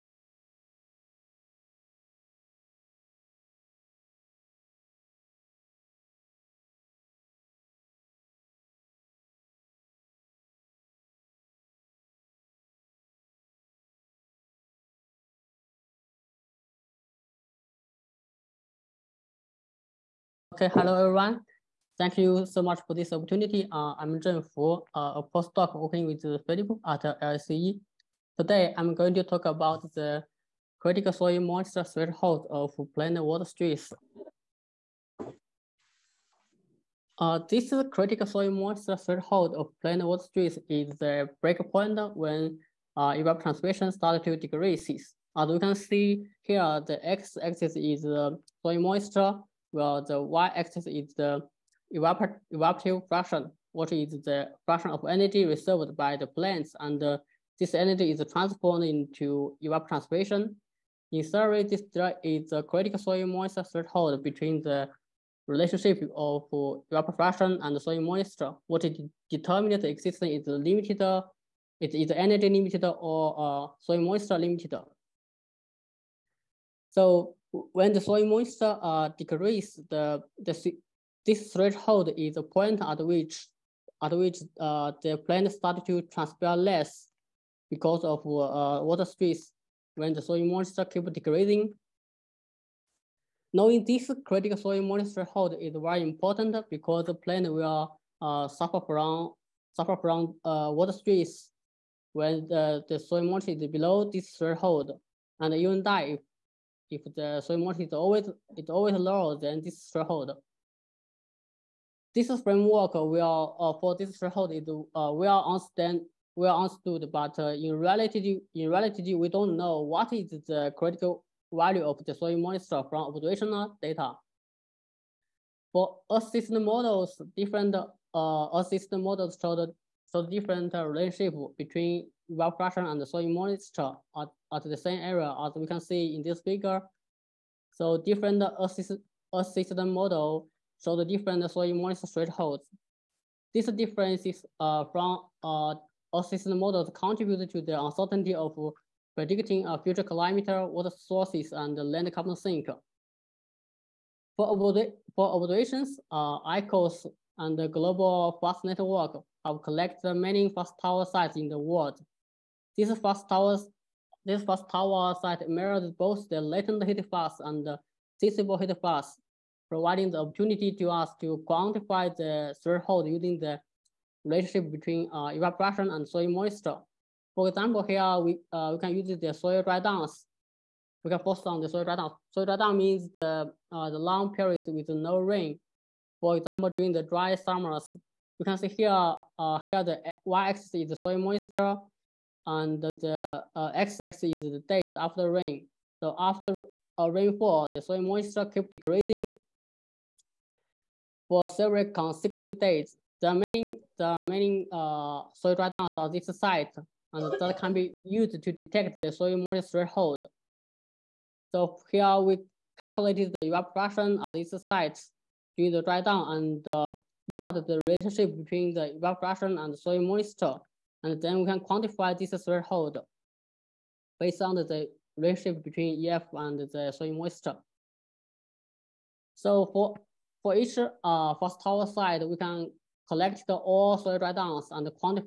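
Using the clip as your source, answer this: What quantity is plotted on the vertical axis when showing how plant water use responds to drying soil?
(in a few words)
Evaporative fraction.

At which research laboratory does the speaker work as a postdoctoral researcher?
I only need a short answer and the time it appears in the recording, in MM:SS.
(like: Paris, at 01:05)
LSCE, at 00:27.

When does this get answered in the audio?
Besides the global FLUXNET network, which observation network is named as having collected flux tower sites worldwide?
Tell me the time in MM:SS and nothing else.
02:36.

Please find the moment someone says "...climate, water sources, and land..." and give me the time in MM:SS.
02:30.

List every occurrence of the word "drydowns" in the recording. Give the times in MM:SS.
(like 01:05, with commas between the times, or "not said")
03:25.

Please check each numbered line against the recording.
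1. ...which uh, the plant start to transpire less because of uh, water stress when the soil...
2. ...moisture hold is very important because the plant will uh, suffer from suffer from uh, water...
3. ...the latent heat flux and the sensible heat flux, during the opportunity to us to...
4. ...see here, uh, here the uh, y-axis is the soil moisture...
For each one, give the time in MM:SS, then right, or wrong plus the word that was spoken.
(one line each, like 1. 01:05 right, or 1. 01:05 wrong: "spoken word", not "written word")
1. 01:24 right
2. 01:34 right
3. 02:46 wrong: "providing", not "during"
4. 03:08 right.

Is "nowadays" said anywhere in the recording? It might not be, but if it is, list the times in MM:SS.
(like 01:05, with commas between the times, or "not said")
not said.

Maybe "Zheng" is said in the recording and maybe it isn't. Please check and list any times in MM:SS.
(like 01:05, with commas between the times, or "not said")
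00:24.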